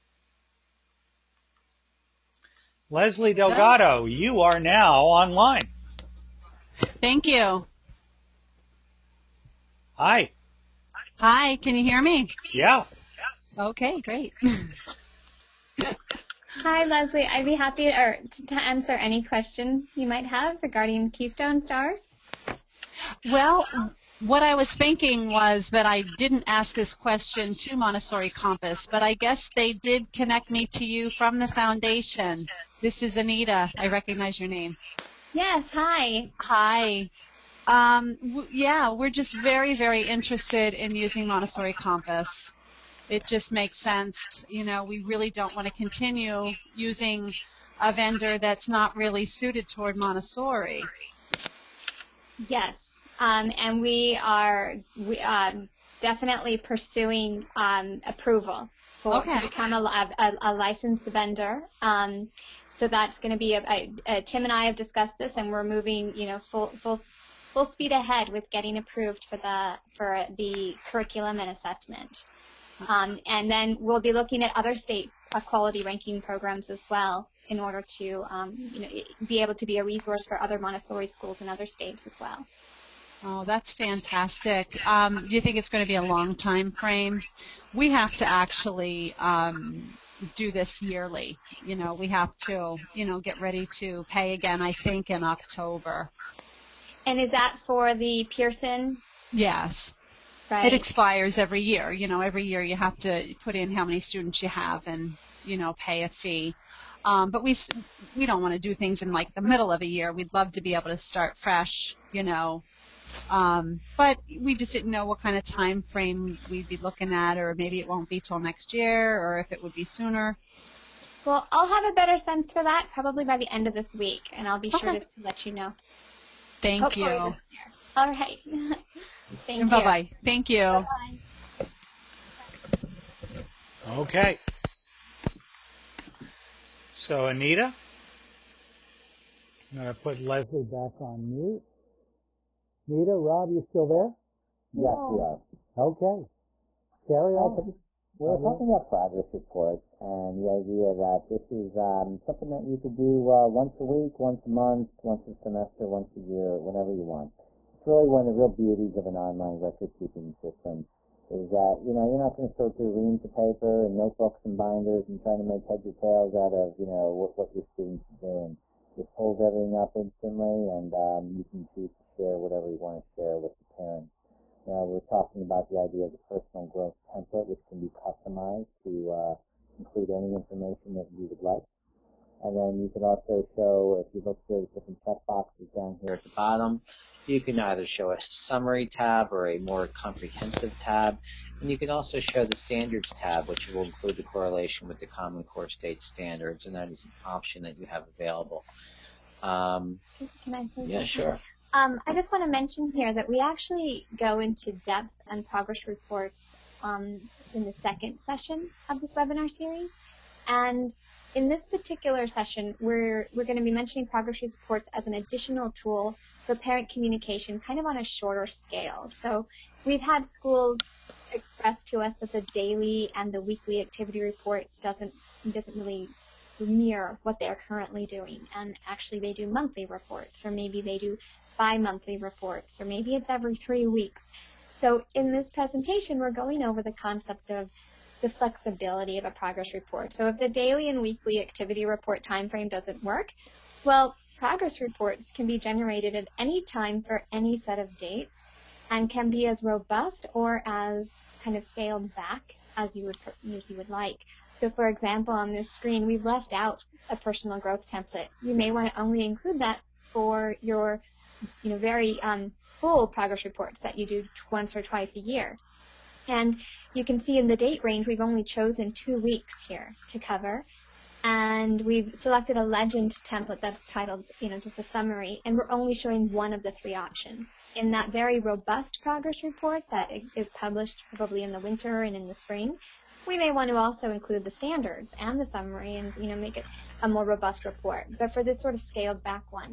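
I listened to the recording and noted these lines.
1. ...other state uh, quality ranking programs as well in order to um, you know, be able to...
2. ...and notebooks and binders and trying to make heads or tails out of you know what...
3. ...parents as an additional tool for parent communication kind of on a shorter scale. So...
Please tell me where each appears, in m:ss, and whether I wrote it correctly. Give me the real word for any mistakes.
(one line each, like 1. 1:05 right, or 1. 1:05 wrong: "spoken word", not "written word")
1. 1:14 right
2. 2:43 right
3. 3:34 wrong: "reports", not "parents".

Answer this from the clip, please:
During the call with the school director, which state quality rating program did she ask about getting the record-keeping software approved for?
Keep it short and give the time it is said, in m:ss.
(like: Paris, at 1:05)
Keystone Stars, at 0:21.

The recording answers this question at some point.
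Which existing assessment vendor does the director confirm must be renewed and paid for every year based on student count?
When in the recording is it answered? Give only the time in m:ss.
1:38.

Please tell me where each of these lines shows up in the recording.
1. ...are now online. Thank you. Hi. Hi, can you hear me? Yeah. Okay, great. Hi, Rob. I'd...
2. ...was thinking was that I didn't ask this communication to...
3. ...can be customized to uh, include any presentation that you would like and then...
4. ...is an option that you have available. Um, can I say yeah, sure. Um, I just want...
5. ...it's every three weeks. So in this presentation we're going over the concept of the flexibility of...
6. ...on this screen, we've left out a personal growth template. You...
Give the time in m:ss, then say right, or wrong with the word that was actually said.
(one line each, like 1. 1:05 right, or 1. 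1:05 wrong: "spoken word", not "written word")
1. 0:04 wrong: "Leslie", not "Rob"
2. 0:24 wrong: "question", not "communication"
3. 2:57 wrong: "information", not "presentation"
4. 3:16 right
5. 3:53 right
6. 4:15 right.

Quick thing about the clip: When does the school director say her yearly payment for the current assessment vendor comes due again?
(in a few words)
October.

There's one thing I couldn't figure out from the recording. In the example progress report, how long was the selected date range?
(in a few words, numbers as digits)
two weeks.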